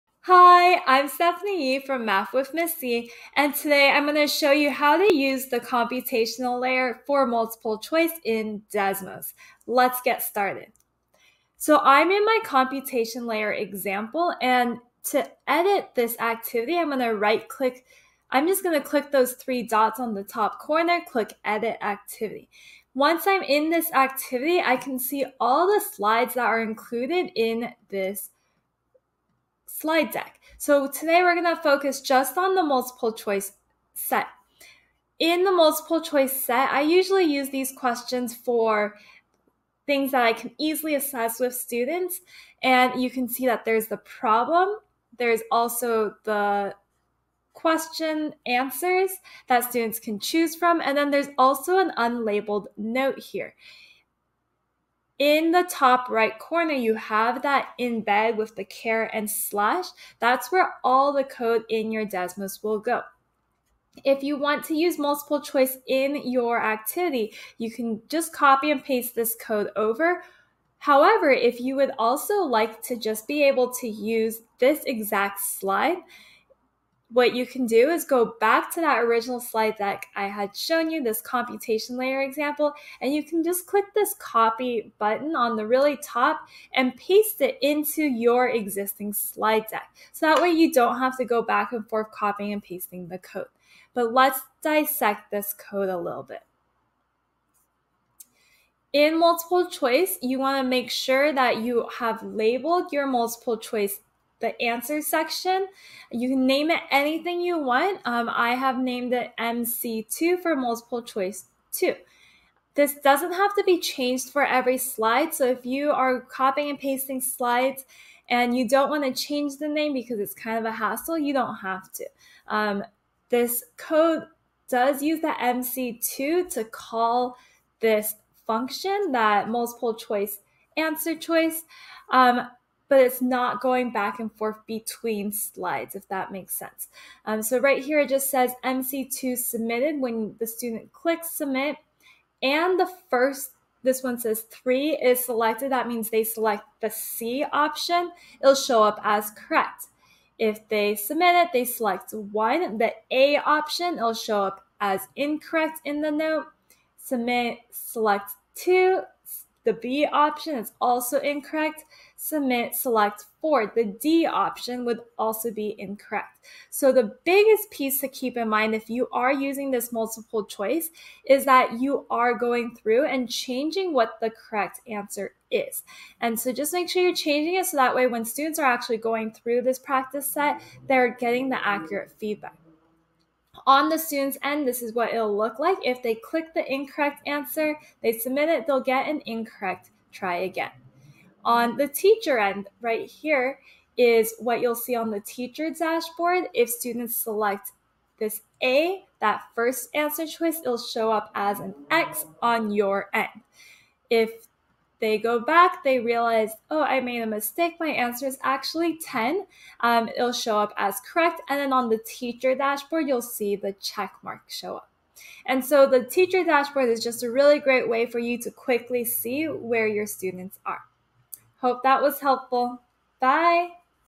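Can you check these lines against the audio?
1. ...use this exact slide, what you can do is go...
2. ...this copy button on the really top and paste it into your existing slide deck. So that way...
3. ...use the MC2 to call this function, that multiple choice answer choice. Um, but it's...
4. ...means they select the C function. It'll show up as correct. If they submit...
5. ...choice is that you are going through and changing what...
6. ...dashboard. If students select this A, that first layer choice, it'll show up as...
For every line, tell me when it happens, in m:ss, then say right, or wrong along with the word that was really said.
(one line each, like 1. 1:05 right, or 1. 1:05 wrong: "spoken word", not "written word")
1. 1:13 right
2. 1:23 right
3. 2:05 right
4. 2:25 wrong: "option", not "function"
5. 2:50 right
6. 3:15 wrong: "answer", not "layer".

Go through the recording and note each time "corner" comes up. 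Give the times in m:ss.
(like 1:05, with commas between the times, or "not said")
0:20, 0:56.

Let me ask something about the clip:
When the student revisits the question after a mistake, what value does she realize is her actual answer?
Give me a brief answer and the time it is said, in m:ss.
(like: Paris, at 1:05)
10, at 3:28.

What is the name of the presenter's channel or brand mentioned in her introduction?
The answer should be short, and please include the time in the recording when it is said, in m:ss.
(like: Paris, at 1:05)
Math with Ms. Yi, at 0:02.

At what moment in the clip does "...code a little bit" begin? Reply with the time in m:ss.
1:35.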